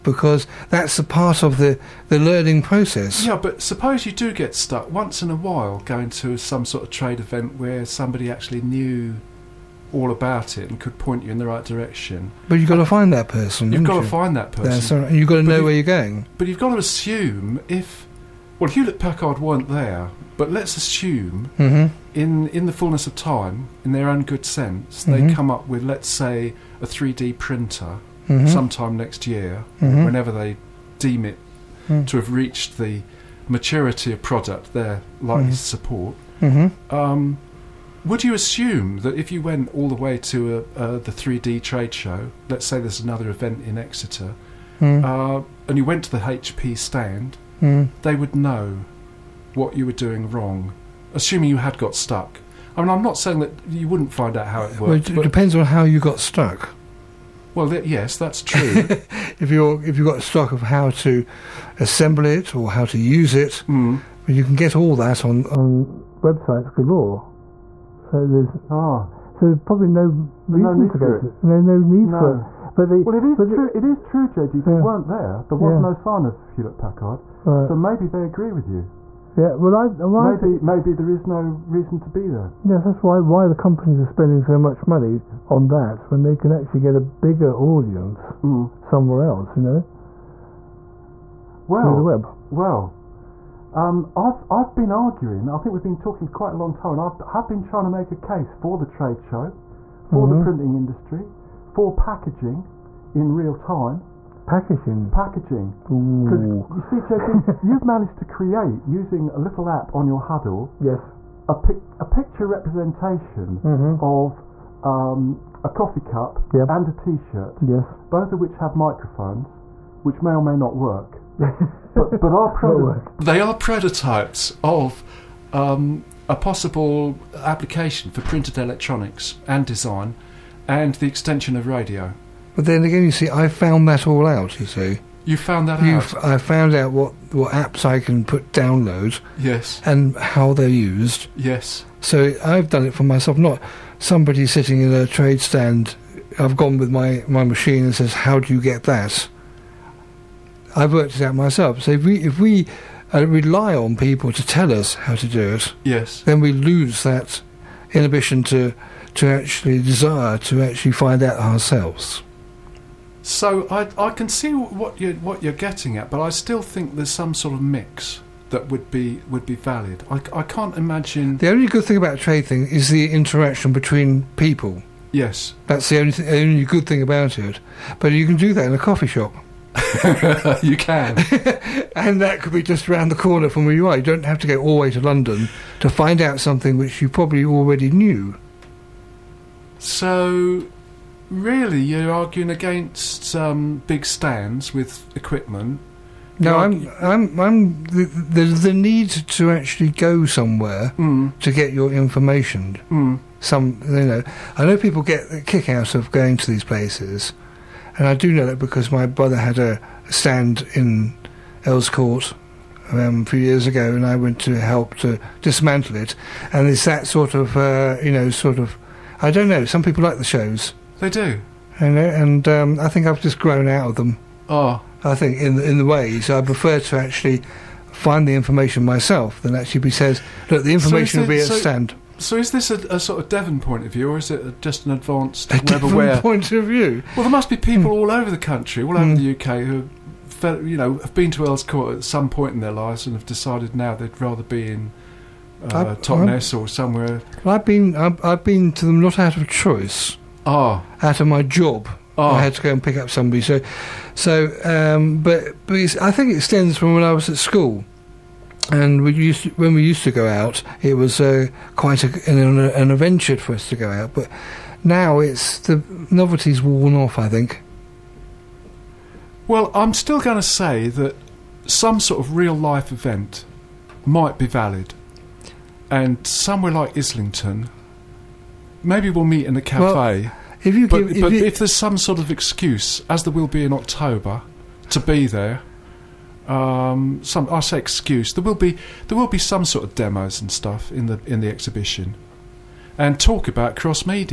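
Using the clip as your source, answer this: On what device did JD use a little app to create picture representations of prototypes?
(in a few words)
Hudl.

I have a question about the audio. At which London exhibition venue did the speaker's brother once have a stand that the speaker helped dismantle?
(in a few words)
Earls Court.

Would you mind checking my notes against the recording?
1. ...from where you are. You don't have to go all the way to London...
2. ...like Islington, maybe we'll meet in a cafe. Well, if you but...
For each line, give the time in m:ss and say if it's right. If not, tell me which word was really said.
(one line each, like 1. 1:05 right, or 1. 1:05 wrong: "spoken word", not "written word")
1. 3:03 right
2. 4:36 right.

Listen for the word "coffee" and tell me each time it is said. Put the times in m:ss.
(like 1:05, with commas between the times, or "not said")
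1:55, 2:58.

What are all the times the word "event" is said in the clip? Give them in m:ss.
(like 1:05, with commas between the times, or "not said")
0:07, 0:43, 4:32.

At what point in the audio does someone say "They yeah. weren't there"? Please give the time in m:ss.
1:14.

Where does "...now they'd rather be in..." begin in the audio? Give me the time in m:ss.
4:03.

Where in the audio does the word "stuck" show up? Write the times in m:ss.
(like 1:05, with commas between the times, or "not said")
0:04, 0:51, 0:56.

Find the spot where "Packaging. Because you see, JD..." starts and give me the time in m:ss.
1:45.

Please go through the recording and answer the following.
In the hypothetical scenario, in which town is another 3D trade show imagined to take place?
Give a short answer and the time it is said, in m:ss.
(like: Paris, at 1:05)
Exeter, at 0:43.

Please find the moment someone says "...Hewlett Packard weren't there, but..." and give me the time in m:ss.
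0:18.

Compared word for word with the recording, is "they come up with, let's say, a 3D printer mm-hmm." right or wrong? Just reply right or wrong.
right.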